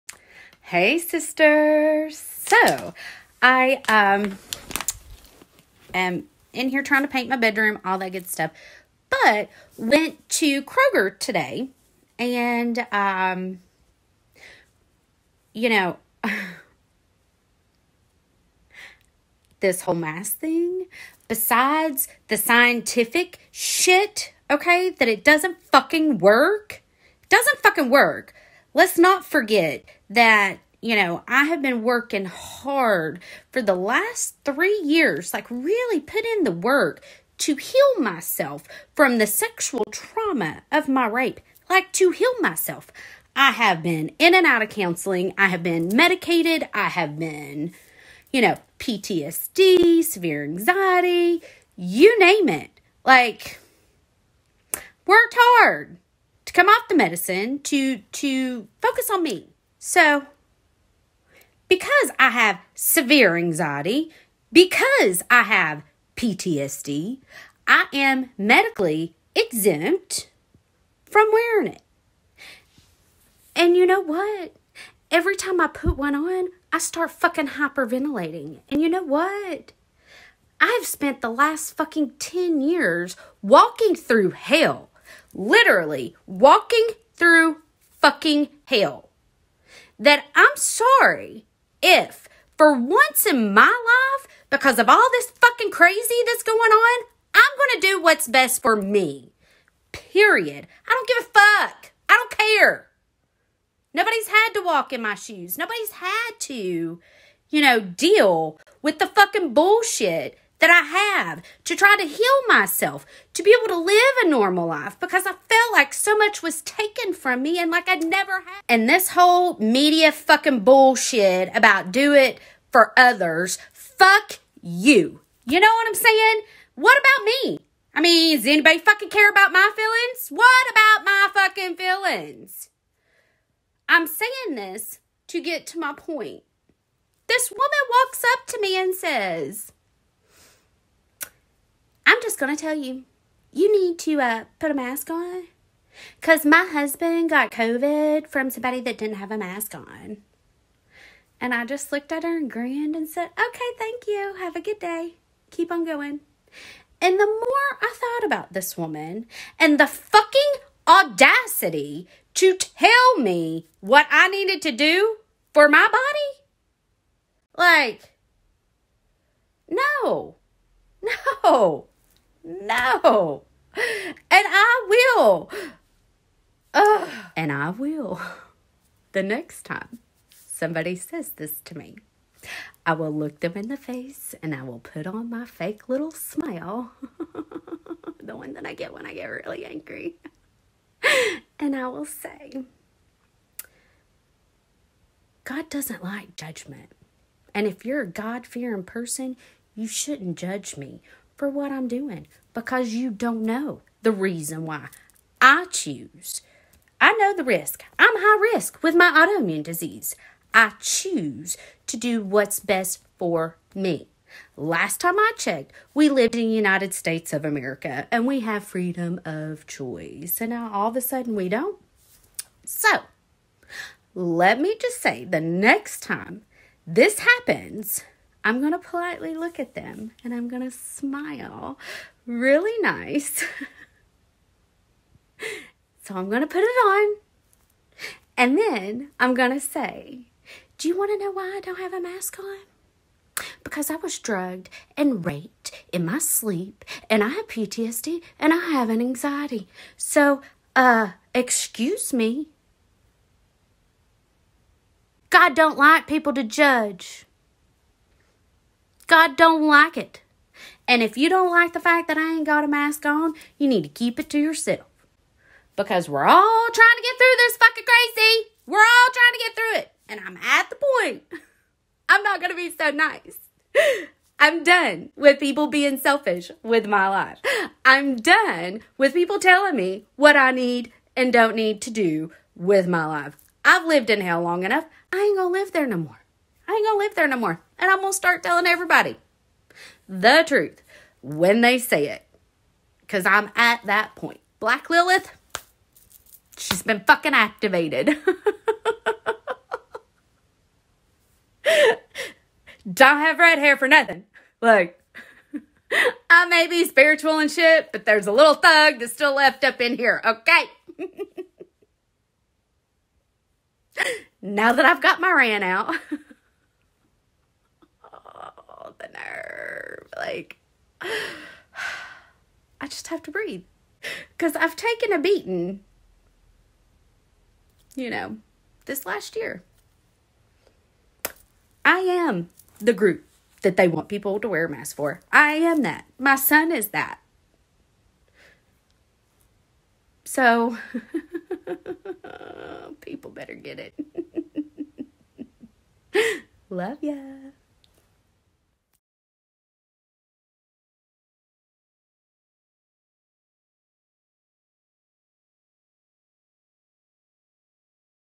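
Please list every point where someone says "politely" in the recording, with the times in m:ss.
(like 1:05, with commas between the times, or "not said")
3:48.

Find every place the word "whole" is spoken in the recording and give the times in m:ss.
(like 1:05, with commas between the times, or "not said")
0:19, 1:59.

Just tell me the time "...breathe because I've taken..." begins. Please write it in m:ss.
5:23.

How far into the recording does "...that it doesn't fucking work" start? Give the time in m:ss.
0:24.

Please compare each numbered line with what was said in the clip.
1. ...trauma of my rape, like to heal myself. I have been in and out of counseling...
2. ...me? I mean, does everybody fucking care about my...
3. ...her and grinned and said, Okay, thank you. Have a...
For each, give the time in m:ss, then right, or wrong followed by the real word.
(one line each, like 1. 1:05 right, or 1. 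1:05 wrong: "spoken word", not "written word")
1. 0:39 right
2. 2:07 wrong: "anybody", not "everybody"
3. 2:32 right.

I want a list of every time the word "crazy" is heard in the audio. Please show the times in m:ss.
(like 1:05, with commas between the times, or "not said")
1:35, 4:27.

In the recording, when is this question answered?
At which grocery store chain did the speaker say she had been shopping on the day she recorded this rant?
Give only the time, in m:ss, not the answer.
0:10.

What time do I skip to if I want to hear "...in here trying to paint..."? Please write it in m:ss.
0:06.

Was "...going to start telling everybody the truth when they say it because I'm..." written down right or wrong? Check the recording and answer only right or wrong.
right.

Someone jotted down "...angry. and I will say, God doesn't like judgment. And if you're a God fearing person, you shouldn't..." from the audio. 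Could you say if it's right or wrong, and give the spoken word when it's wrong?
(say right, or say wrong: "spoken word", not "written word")
right.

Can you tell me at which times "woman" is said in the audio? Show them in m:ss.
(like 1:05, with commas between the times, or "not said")
2:17, 2:38.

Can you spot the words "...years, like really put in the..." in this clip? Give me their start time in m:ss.
0:34.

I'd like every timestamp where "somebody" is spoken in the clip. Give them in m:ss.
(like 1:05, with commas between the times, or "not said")
2:28, 3:00.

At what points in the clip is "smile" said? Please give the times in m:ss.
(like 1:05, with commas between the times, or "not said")
3:06, 3:50.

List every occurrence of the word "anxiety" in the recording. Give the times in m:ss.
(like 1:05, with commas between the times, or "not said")
0:50, 1:03, 4:09.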